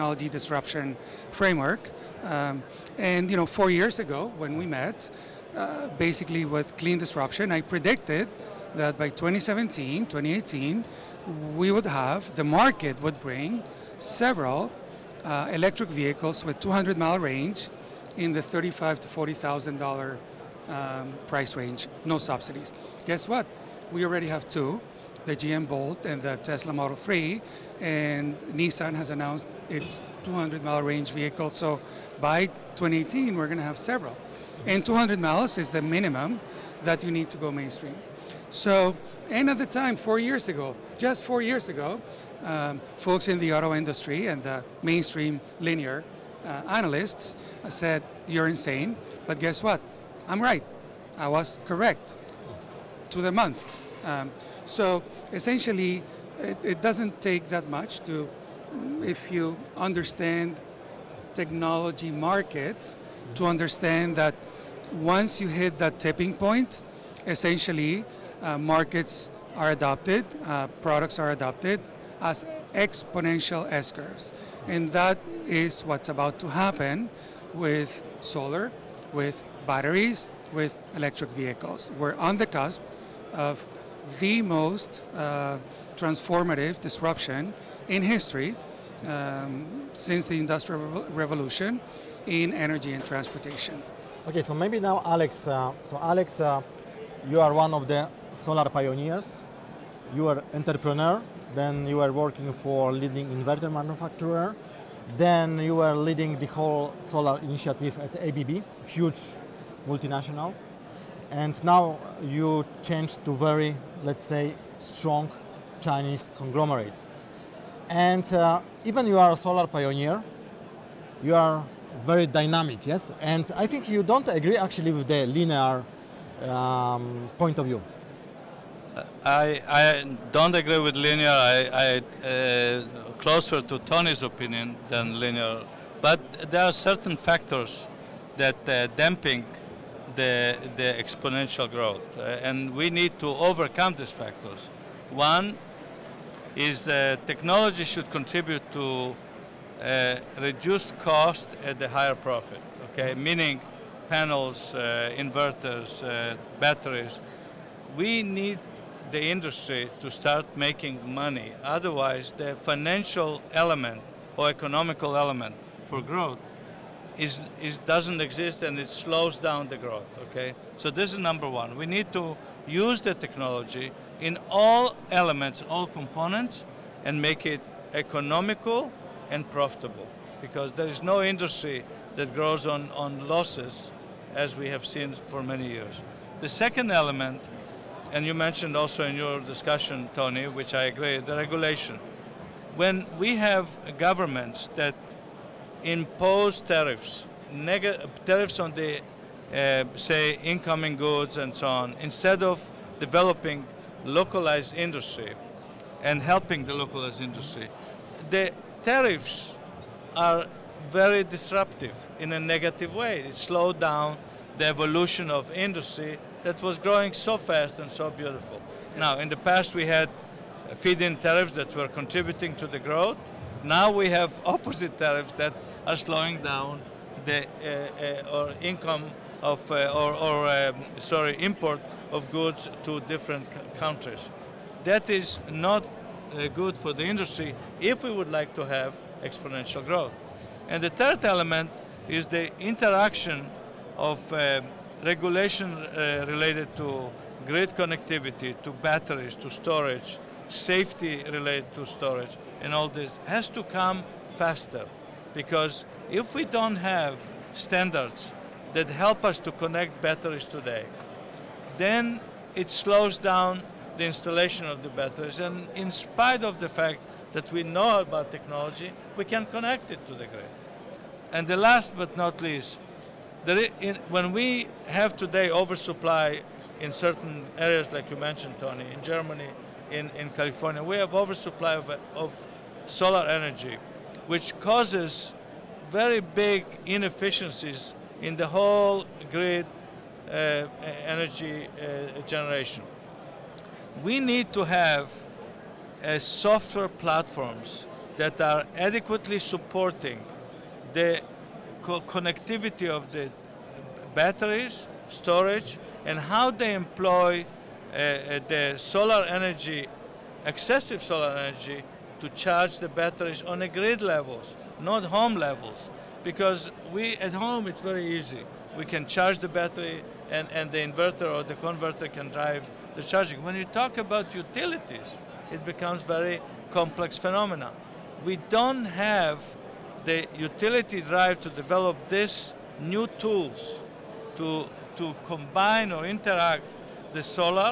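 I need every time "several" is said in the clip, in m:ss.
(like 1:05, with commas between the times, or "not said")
0:13, 0:33.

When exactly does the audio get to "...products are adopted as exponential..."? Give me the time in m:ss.
1:10.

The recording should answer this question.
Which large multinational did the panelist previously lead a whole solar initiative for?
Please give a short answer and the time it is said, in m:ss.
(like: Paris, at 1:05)
ABB, at 1:48.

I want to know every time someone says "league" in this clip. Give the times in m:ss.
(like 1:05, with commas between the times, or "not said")
not said.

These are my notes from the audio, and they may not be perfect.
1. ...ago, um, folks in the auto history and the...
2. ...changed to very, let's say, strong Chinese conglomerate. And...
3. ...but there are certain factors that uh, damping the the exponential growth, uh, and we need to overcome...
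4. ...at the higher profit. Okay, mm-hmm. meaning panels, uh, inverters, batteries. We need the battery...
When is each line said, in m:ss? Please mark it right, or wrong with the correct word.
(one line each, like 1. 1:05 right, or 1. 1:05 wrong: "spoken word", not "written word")
1. 0:41 wrong: "industry", not "history"
2. 1:52 right
3. 2:16 right
4. 2:31 wrong: "industry", not "battery".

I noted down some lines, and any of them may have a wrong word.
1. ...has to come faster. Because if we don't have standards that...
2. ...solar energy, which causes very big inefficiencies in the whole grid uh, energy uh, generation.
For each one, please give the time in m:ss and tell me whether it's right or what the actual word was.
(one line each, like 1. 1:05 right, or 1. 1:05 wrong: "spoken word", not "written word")
1. 4:13 right
2. 4:42 right.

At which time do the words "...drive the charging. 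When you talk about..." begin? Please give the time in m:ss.
5:22.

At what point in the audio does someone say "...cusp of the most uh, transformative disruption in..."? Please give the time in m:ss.
1:22.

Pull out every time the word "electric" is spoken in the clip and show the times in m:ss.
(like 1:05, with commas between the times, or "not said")
0:15, 1:20.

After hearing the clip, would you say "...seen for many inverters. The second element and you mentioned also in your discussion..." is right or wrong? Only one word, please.
wrong.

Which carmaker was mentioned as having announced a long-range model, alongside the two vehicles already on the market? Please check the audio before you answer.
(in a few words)
Nissan.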